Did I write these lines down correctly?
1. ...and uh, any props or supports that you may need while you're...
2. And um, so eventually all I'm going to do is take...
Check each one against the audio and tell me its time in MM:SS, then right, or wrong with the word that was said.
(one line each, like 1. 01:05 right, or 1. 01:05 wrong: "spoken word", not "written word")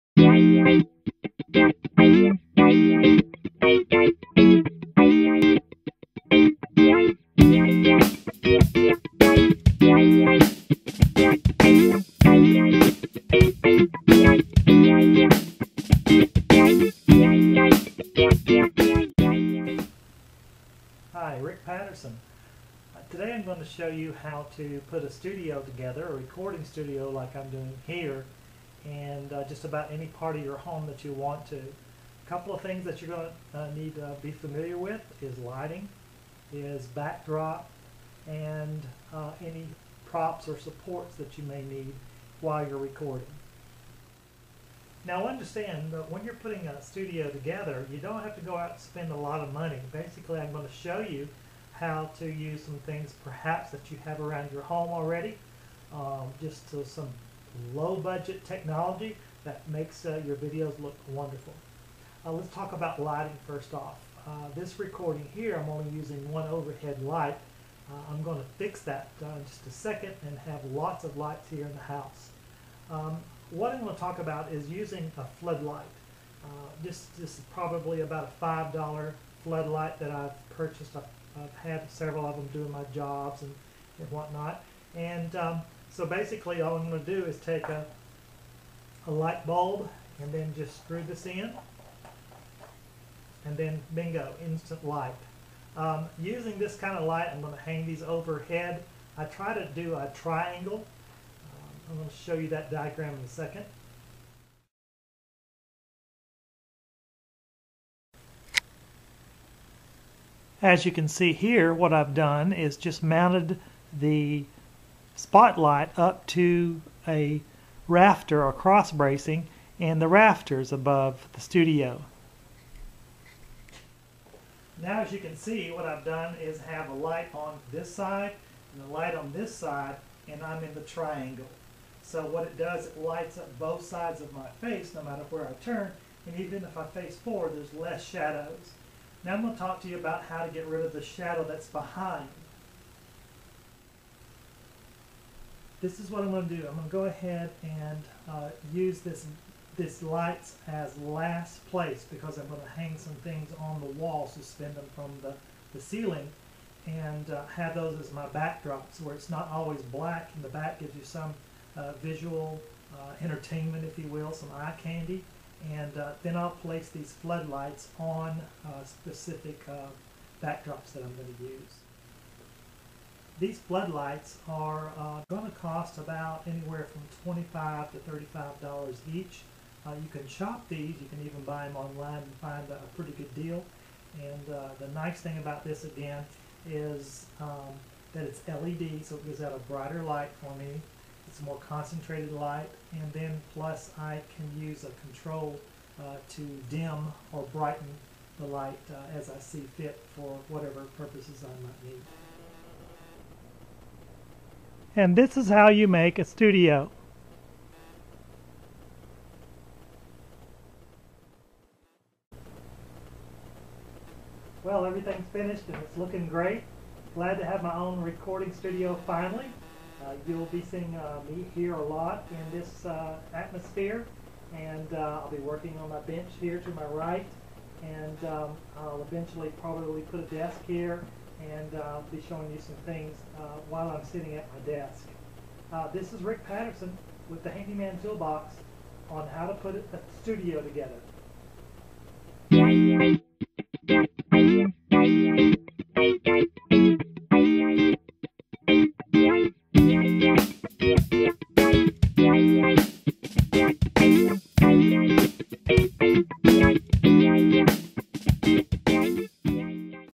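1. 00:38 right
2. 01:24 wrong: "basically", not "eventually".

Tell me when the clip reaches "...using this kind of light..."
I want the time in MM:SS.
01:36.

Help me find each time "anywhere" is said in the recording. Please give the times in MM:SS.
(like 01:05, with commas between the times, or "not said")
02:56.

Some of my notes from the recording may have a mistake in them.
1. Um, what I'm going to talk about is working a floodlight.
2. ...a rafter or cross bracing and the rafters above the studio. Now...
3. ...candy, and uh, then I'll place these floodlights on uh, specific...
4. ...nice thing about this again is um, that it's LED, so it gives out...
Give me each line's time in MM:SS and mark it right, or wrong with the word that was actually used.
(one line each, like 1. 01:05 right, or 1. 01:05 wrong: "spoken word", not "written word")
1. 01:12 wrong: "using", not "working"
2. 01:57 right
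3. 02:44 right
4. 03:04 right.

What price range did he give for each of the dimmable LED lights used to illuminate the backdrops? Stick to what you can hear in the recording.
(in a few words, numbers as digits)
$25 to $35.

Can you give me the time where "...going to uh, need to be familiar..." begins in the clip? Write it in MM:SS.
00:33.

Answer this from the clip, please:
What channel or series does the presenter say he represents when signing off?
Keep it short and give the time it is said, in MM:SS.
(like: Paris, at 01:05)
Handyman Toolbox, at 03:57.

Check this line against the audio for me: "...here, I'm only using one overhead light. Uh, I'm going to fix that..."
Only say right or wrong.
right.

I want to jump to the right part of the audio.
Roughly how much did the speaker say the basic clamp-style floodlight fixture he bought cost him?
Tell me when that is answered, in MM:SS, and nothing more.
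01:18.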